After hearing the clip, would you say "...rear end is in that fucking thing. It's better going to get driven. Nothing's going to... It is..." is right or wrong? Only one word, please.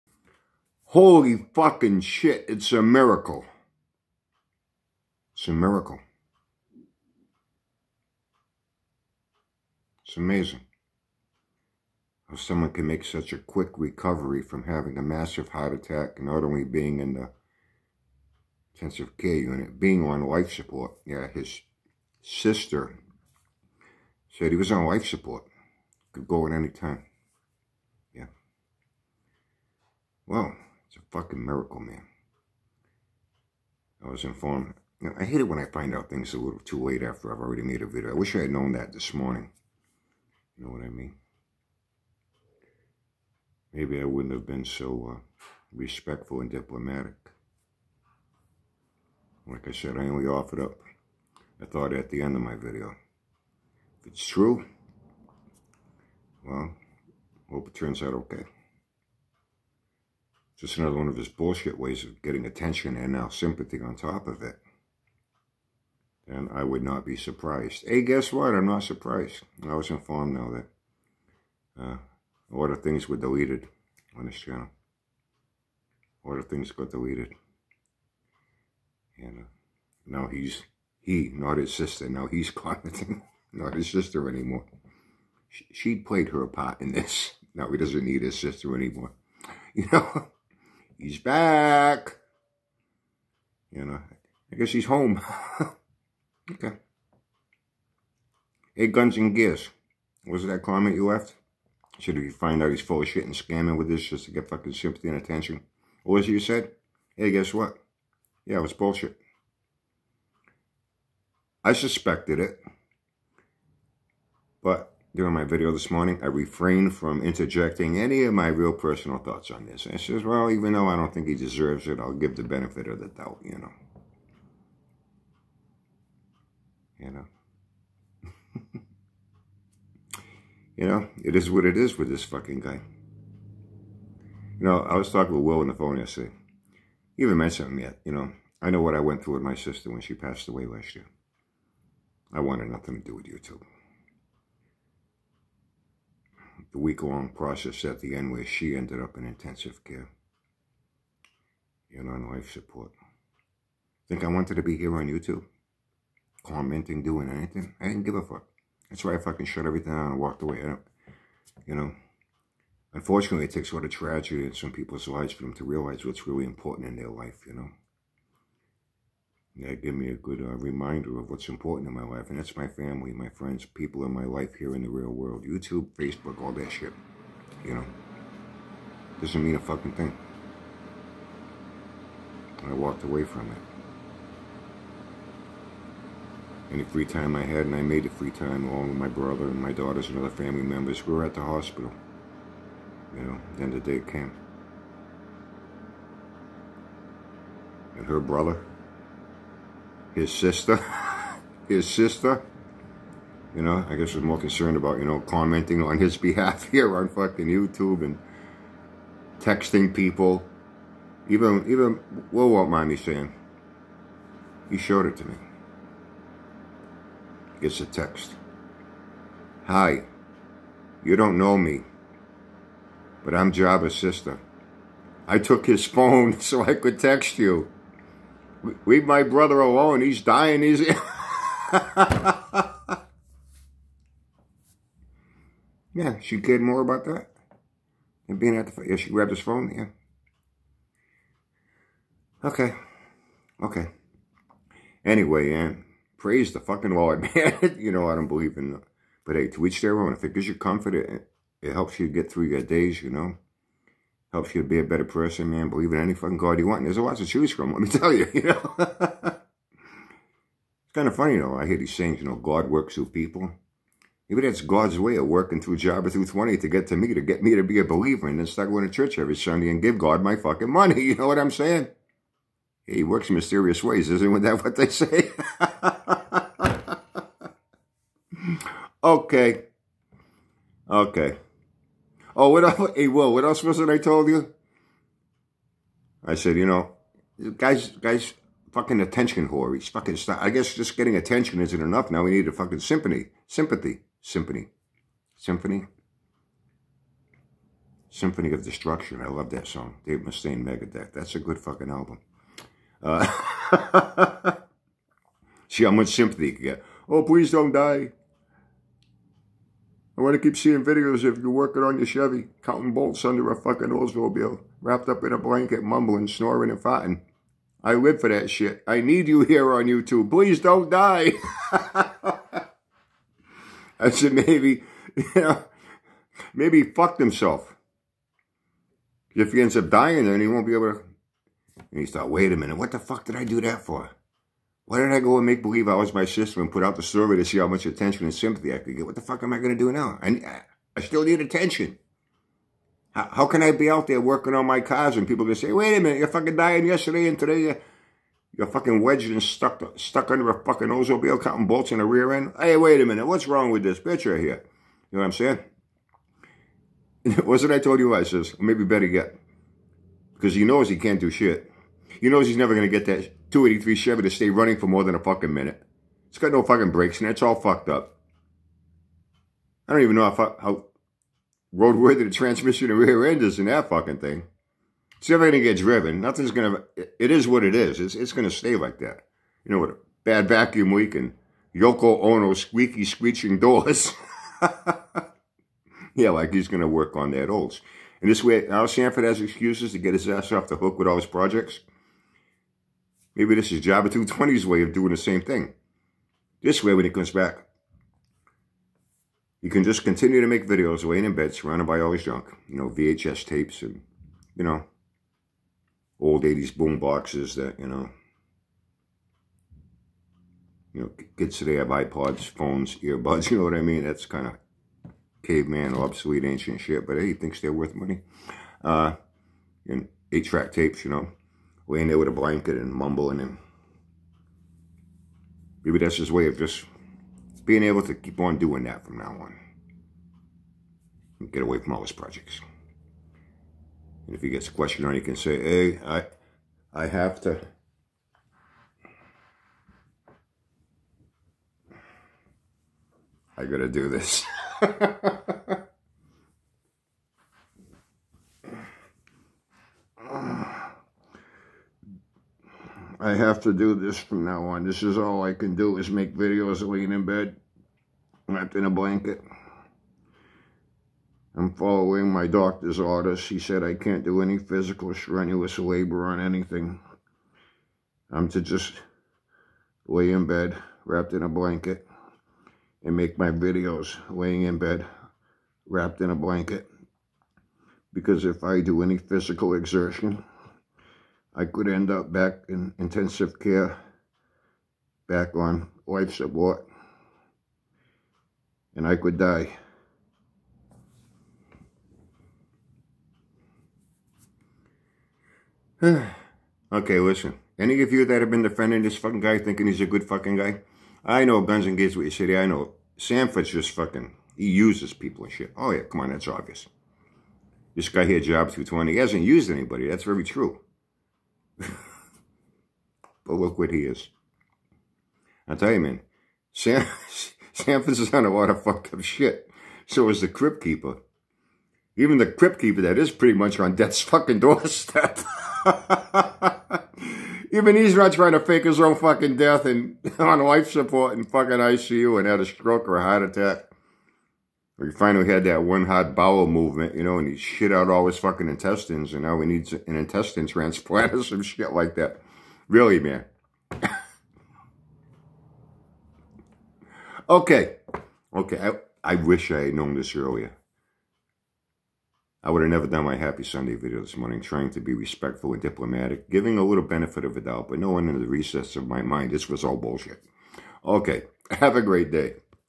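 wrong.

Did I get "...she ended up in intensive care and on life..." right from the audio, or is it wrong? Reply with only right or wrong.
right.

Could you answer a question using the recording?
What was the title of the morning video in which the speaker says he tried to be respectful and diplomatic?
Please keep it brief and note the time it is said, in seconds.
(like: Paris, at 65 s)
Happy Sunday, at 553 s.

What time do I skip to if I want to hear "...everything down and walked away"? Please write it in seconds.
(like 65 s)
159 s.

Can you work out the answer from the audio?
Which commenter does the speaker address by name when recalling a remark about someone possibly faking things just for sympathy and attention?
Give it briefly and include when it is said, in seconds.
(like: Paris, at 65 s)
Guns and Gears, at 98 s.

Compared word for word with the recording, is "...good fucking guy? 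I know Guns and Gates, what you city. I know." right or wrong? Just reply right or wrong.
right.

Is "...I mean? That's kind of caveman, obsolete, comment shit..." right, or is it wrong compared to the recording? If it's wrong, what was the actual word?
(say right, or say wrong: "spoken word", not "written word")
wrong: "ancient", not "comment".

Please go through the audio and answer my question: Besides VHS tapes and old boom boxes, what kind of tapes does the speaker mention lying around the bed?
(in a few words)
Eight-track tapes.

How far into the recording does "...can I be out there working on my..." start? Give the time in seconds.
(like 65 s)
343 s.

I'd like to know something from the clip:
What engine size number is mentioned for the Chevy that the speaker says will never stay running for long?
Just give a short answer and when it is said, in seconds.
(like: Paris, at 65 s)
283, at 363 s.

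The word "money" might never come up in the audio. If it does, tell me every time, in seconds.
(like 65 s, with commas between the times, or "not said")
270 s, 417 s.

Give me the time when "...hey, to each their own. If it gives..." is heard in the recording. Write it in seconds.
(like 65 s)
249 s.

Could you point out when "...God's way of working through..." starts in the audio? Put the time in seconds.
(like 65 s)
264 s.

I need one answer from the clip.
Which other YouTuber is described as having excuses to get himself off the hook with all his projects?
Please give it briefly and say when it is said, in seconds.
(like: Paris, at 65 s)
Al Sanford, at 388 s.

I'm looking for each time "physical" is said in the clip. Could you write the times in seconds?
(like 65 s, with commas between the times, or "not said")
464 s, 479 s.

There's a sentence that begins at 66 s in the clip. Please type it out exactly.
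And I would not be surprised.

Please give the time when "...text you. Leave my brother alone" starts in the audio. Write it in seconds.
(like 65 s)
226 s.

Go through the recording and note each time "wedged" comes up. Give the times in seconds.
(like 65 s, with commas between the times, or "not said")
349 s.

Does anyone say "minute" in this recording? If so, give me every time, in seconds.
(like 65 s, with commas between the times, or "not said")
332 s, 346 s, 353 s, 365 s.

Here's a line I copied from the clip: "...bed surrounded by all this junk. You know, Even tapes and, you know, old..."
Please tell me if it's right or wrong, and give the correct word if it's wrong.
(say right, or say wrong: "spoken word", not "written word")
wrong: "VHS", not "Even".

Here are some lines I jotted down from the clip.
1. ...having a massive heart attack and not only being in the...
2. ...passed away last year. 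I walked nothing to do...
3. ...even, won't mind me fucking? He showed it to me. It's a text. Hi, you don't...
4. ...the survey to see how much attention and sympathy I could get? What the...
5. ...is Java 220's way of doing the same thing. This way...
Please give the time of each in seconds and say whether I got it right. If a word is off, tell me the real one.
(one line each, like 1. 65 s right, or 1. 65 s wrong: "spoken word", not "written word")
1. 14 s right
2. 140 s wrong: "wanted", not "walked"
3. 211 s wrong: "saying", not "fucking"
4. 336 s right
5. 393 s right.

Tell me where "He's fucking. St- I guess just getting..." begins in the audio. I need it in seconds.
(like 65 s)
289 s.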